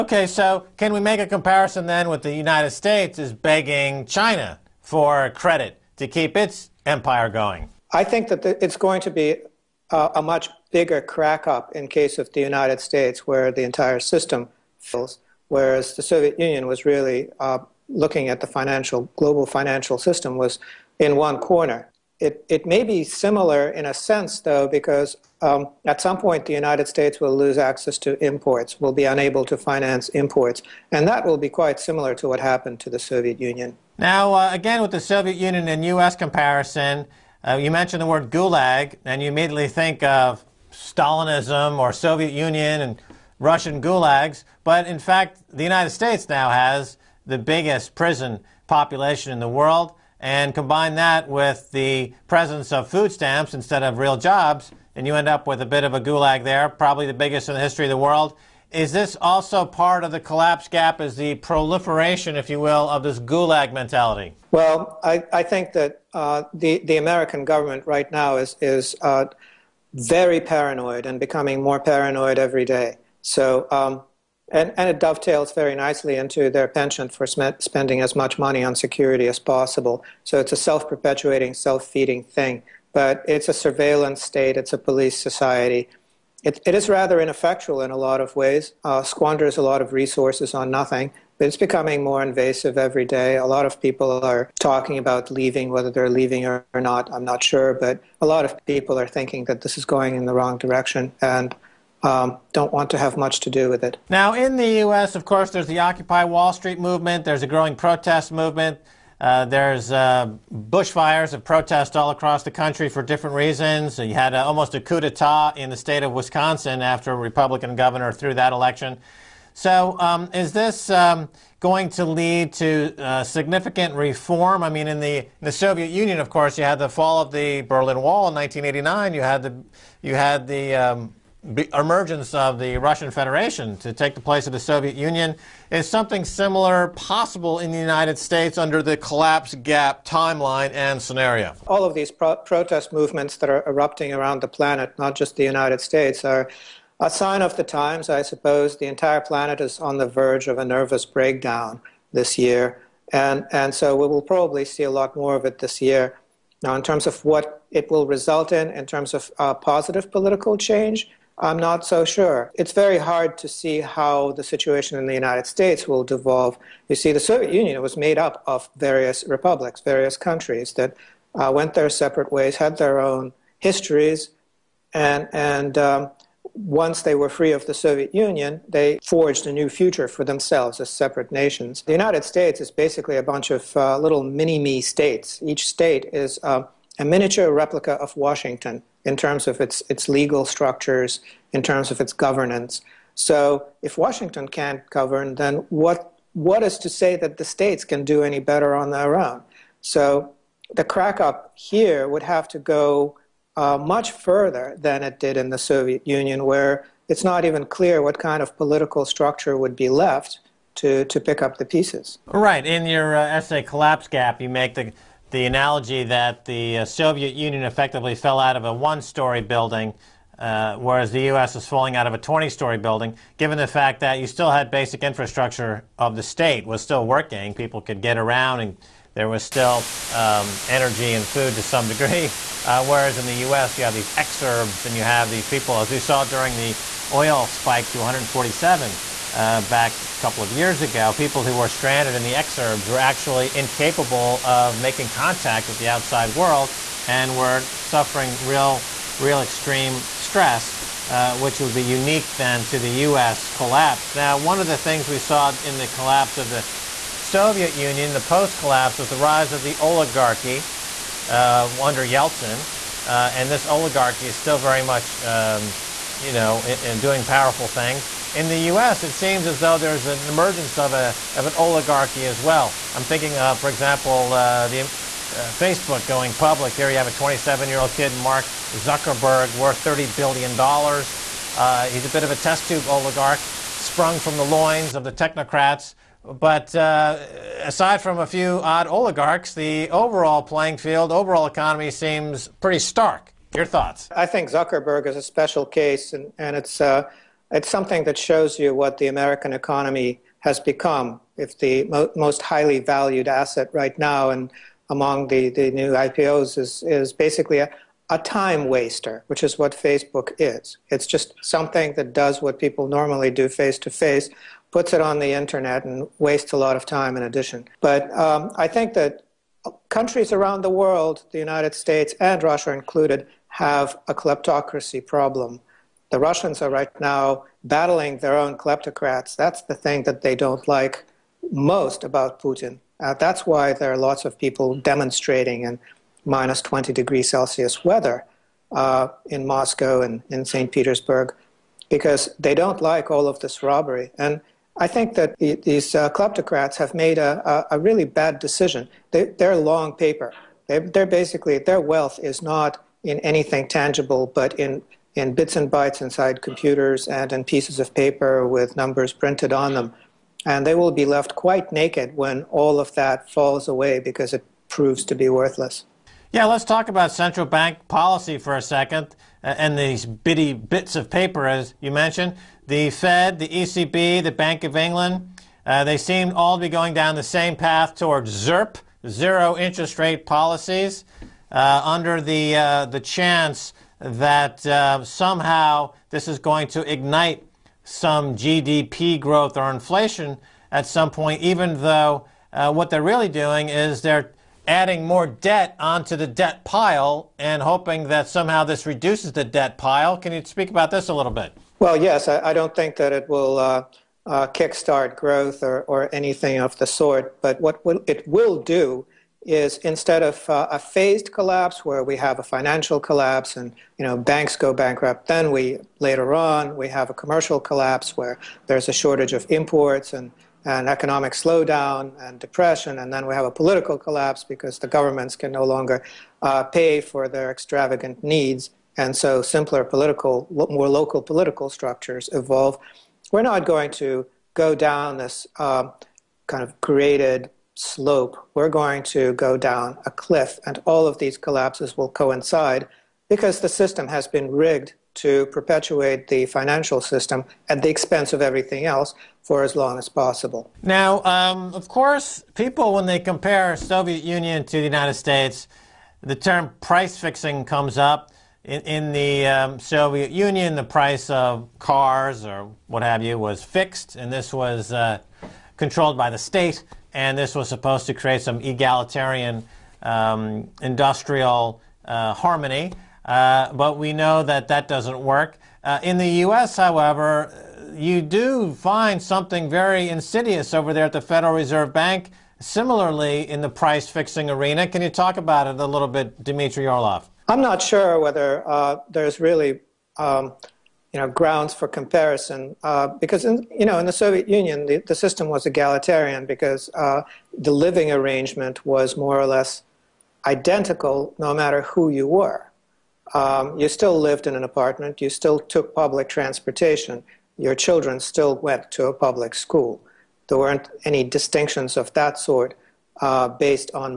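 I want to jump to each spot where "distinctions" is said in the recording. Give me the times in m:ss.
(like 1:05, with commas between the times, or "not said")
8:31.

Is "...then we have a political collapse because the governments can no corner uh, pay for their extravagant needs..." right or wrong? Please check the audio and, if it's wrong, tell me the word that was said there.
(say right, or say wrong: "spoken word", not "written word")
wrong: "longer", not "corner".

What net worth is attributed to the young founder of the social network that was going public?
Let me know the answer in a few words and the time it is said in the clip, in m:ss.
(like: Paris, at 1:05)
$30 billion, at 4:39.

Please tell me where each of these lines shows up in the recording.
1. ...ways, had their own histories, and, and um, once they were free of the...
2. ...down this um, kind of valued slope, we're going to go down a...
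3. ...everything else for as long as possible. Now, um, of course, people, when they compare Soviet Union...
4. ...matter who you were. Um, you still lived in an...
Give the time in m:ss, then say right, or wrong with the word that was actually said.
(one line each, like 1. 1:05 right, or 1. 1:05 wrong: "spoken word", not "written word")
1. 2:52 right
2. 7:14 wrong: "created", not "valued"
3. 7:28 right
4. 8:21 right.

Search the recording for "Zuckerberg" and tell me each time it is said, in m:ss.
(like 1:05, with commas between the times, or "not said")
4:38, 4:54.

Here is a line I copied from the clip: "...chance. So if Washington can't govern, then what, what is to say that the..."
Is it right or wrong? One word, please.
wrong.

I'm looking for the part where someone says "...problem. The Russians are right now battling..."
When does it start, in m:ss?
5:25.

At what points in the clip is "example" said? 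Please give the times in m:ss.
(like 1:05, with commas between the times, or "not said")
4:33.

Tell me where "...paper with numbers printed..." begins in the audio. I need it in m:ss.
5:57.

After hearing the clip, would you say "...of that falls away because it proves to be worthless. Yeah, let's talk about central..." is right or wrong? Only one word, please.
right.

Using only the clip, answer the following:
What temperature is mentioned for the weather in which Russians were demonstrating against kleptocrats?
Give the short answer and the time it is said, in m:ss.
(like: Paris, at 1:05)
minus 20 degrees Celsius, at 5:36.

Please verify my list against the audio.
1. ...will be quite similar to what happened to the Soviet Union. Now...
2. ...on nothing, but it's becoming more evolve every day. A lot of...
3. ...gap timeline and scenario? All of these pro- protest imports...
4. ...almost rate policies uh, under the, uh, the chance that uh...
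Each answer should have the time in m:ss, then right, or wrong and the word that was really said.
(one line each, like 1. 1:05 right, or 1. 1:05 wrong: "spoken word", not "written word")
1. 0:31 right
2. 1:30 wrong: "invasive", not "evolve"
3. 2:19 wrong: "movements", not "imports"
4. 6:19 wrong: "interest", not "almost".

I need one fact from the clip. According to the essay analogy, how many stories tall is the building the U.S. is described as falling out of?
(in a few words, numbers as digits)
20.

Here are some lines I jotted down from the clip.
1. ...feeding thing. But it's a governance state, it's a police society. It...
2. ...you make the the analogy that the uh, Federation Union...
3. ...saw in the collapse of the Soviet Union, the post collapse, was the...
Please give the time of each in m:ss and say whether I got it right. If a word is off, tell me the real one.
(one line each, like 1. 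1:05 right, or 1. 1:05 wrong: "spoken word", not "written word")
1. 1:21 wrong: "surveillance", not "governance"
2. 3:34 wrong: "Soviet", not "Federation"
3. 4:15 right.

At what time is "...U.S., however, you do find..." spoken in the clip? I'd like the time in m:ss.
7:56.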